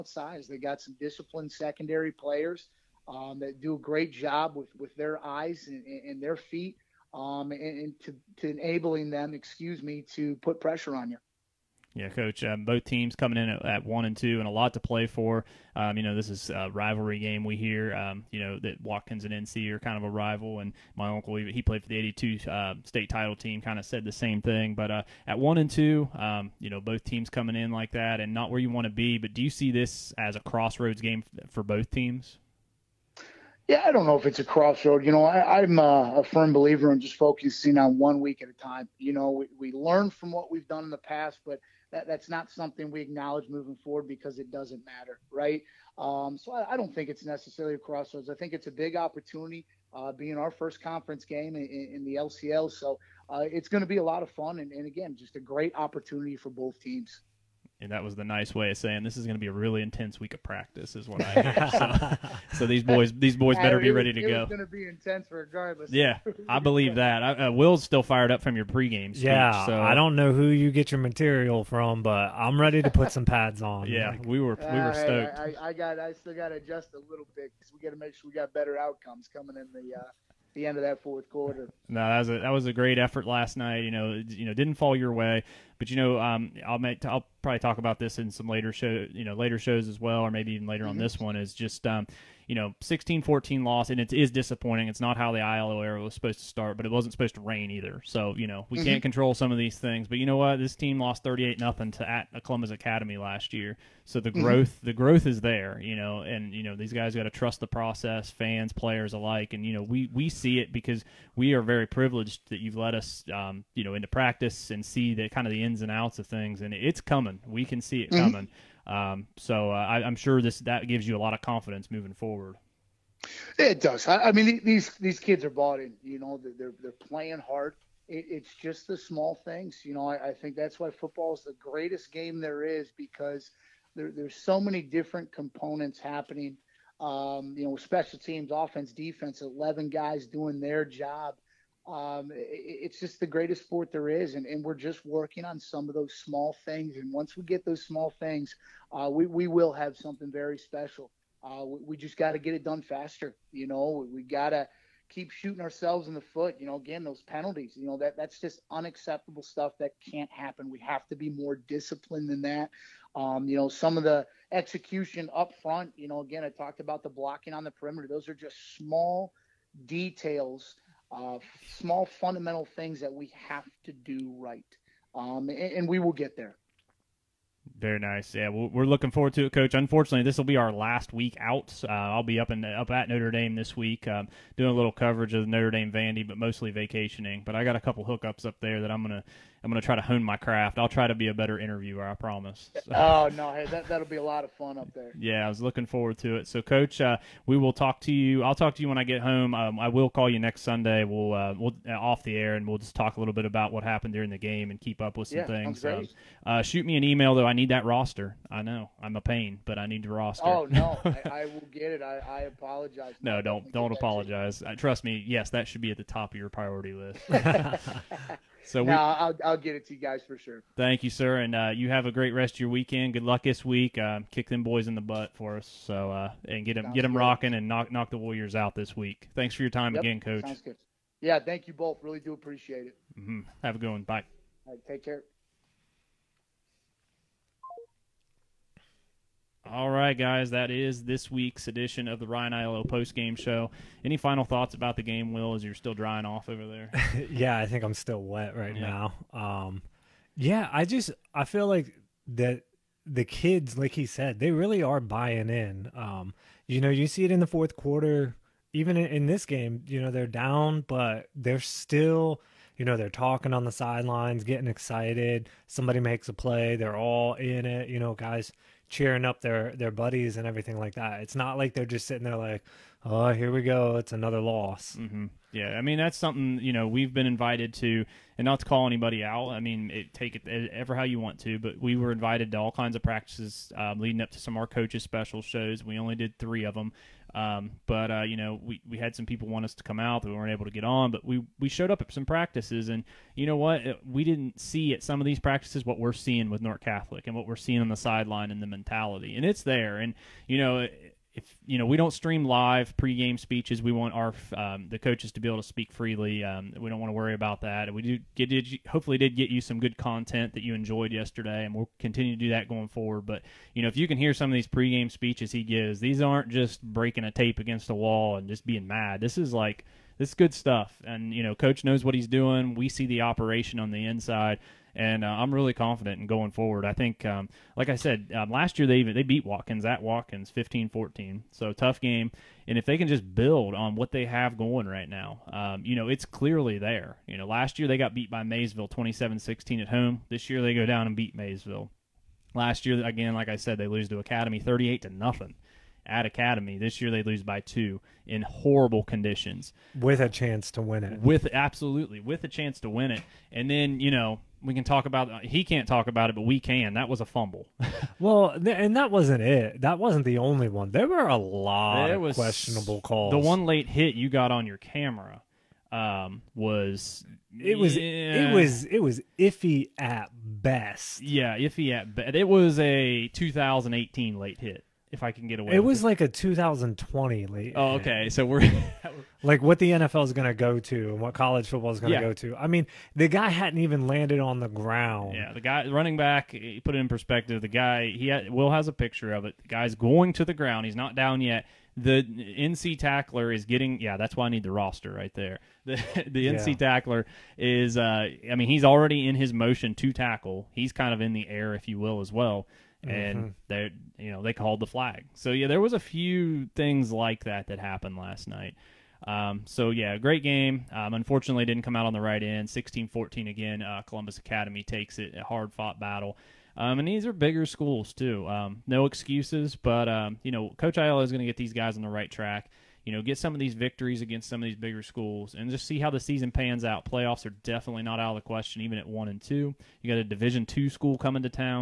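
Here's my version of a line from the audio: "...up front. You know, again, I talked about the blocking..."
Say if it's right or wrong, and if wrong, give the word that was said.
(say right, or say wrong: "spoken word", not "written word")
right.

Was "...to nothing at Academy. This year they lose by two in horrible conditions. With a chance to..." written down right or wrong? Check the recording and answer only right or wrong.
right.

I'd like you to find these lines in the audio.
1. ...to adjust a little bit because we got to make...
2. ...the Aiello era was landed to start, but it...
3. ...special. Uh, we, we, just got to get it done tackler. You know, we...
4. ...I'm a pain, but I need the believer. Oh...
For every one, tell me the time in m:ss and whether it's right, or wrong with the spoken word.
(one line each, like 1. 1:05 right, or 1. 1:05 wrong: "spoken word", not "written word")
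1. 1:16 right
2. 1:35 wrong: "supposed", not "landed"
3. 2:30 wrong: "faster", not "tackler"
4. 3:29 wrong: "roster", not "believer".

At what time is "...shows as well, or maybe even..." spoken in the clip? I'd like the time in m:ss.
1:29.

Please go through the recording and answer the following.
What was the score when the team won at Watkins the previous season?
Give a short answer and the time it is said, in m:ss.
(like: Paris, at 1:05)
15-14, at 5:30.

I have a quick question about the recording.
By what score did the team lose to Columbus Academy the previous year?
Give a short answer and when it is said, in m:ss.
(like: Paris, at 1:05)
38-0, at 1:41.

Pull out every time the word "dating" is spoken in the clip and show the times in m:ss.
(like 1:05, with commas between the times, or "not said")
not said.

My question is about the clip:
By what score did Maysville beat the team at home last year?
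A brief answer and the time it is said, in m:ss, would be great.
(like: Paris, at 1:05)
27-16, at 5:38.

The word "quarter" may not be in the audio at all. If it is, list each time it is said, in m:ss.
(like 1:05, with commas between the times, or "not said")
1:21, 4:17.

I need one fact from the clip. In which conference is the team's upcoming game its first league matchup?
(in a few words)
LCL.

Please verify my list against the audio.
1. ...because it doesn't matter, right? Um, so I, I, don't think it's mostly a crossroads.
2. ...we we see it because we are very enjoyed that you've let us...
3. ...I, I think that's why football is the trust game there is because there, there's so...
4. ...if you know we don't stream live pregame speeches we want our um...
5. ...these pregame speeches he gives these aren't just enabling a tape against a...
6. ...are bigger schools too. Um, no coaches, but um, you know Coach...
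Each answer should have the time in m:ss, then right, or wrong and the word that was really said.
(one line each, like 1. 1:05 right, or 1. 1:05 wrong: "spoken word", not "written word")
1. 0:44 wrong: "necessarily", not "mostly"
2. 1:49 wrong: "privileged", not "enjoyed"
3. 2:10 wrong: "greatest", not "trust"
4. 5:01 right
5. 5:14 wrong: "breaking", not "enabling"
6. 6:57 wrong: "excuses", not "coaches".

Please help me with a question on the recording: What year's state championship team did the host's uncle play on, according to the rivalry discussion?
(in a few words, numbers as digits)
1982.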